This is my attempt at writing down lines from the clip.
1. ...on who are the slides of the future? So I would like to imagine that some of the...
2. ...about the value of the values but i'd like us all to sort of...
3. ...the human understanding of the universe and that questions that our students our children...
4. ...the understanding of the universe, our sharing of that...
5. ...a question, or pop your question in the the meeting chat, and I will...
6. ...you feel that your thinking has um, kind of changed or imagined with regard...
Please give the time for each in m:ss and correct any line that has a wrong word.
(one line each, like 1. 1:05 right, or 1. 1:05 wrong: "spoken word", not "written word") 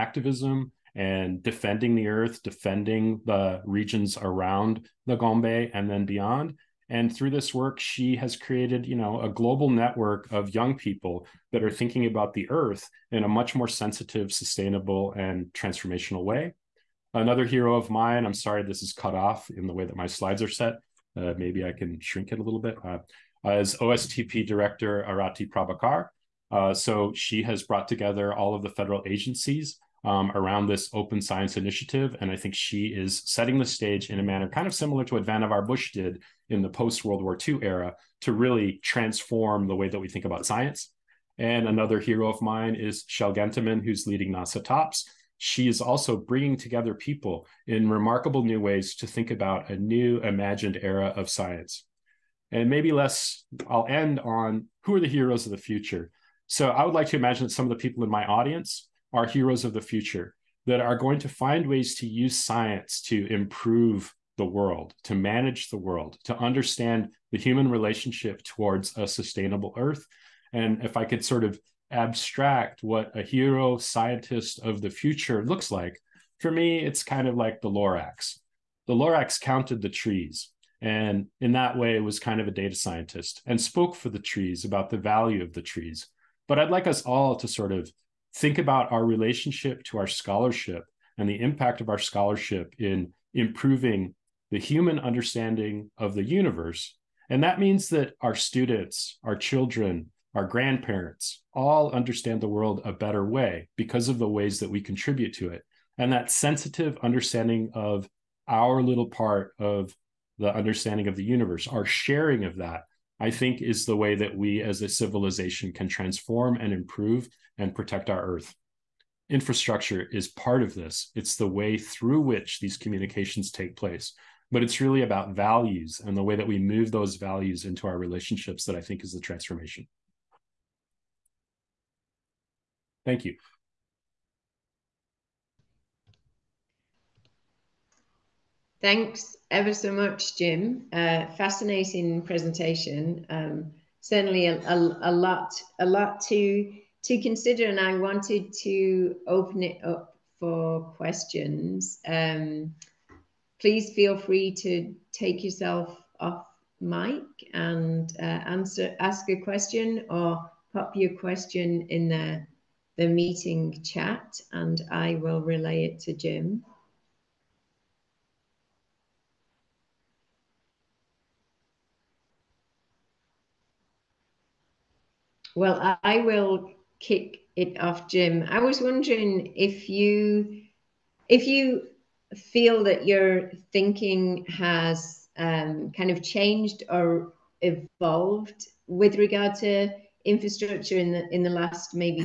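1. 0:54 wrong: "heroes", not "slides"
2. 1:24 wrong: "trees", not "values"
3. 1:34 wrong: "means", not "questions"
4. 1:50 right
5. 2:39 right
6. 3:01 wrong: "evolved", not "imagined".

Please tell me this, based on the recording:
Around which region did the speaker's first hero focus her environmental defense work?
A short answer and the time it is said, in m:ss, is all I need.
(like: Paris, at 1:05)
Gombe, at 0:05.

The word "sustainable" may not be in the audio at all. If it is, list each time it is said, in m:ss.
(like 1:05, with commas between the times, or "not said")
0:14, 1:09.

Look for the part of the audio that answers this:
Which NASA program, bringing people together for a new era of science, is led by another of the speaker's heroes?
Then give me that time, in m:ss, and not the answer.
0:44.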